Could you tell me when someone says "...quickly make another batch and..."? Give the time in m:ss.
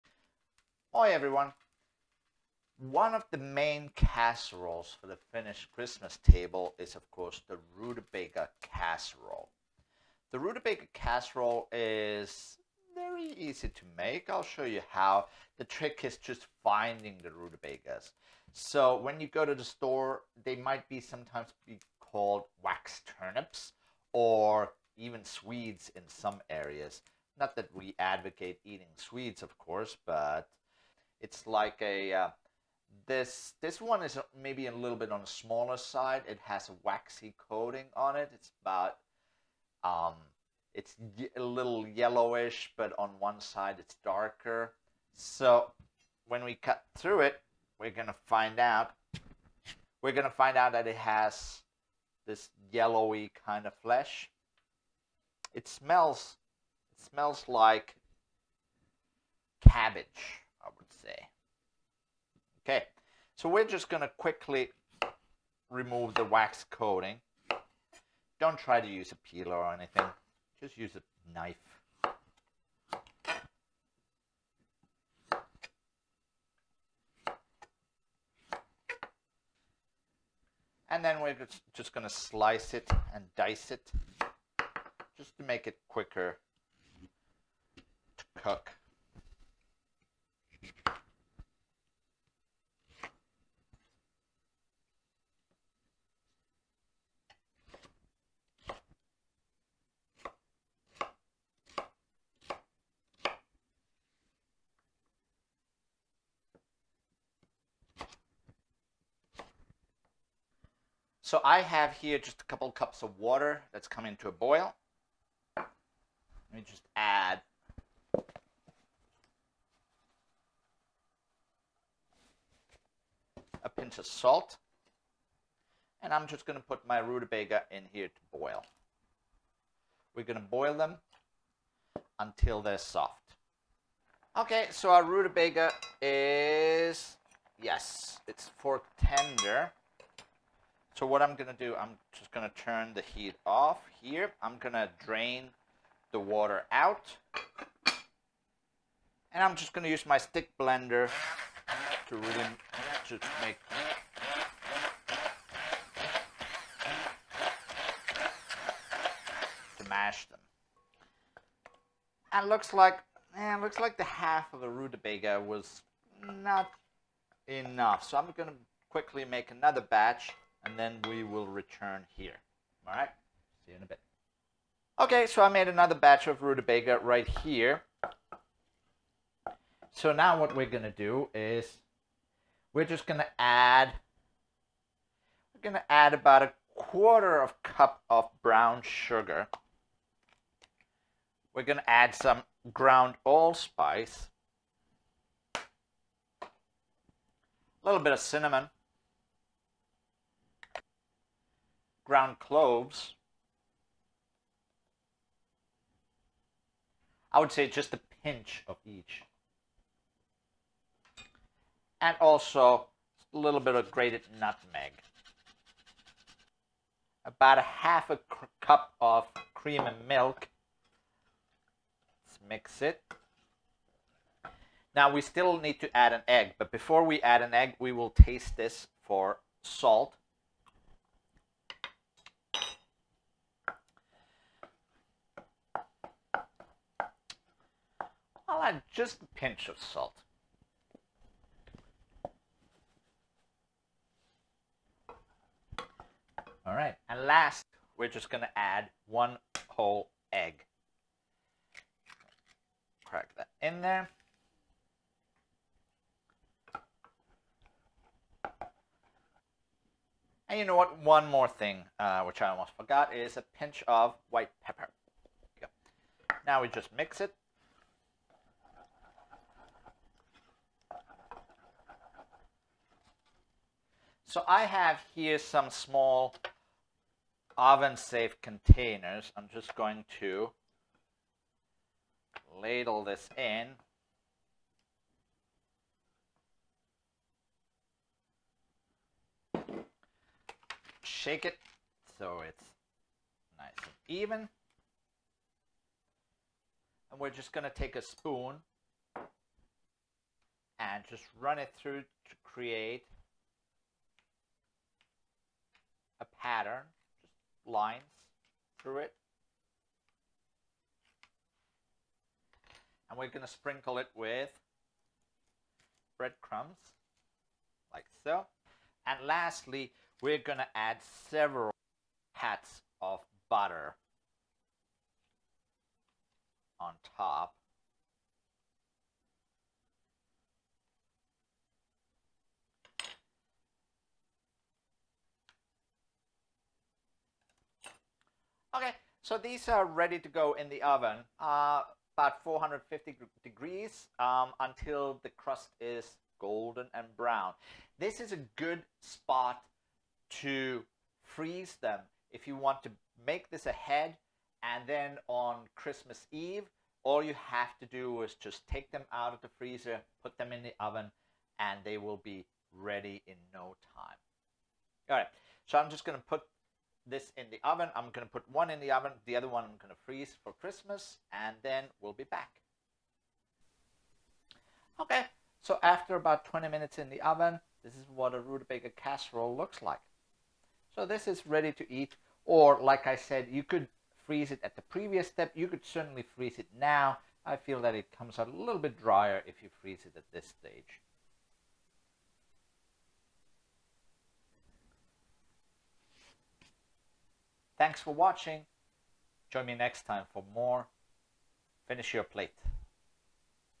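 2:48.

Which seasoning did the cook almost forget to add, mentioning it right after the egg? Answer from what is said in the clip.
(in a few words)
white pepper.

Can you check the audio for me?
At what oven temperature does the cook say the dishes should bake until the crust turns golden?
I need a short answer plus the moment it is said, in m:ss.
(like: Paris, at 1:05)
450 degrees, at 5:42.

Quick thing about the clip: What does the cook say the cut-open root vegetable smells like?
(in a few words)
cabbage.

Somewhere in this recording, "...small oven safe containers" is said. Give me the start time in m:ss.
4:35.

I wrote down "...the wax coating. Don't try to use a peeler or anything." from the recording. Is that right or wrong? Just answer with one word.
right.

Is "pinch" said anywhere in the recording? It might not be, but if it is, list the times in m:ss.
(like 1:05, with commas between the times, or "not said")
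2:03, 3:28, 3:59, 4:23.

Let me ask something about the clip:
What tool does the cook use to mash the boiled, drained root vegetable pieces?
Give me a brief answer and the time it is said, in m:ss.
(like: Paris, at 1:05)
stick blender, at 2:30.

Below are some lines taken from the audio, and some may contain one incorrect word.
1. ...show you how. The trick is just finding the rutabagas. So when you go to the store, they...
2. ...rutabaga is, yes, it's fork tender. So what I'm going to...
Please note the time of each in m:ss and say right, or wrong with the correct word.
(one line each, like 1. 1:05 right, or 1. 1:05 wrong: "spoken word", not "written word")
1. 0:14 right
2. 2:15 right.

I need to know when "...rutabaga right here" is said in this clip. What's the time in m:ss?
2:56.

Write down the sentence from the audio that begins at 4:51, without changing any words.
Shake it so it's nice and even.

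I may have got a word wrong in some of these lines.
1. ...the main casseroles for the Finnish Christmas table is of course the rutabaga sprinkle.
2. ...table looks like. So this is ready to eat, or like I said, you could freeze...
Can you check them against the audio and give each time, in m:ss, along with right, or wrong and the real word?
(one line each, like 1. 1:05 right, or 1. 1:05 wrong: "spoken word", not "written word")
1. 0:03 wrong: "casserole", not "sprinkle"
2. 6:18 wrong: "casserole", not "table".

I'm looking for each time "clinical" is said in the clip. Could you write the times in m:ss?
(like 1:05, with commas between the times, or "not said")
not said.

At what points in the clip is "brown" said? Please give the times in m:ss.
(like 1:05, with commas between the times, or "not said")
3:08, 5:47.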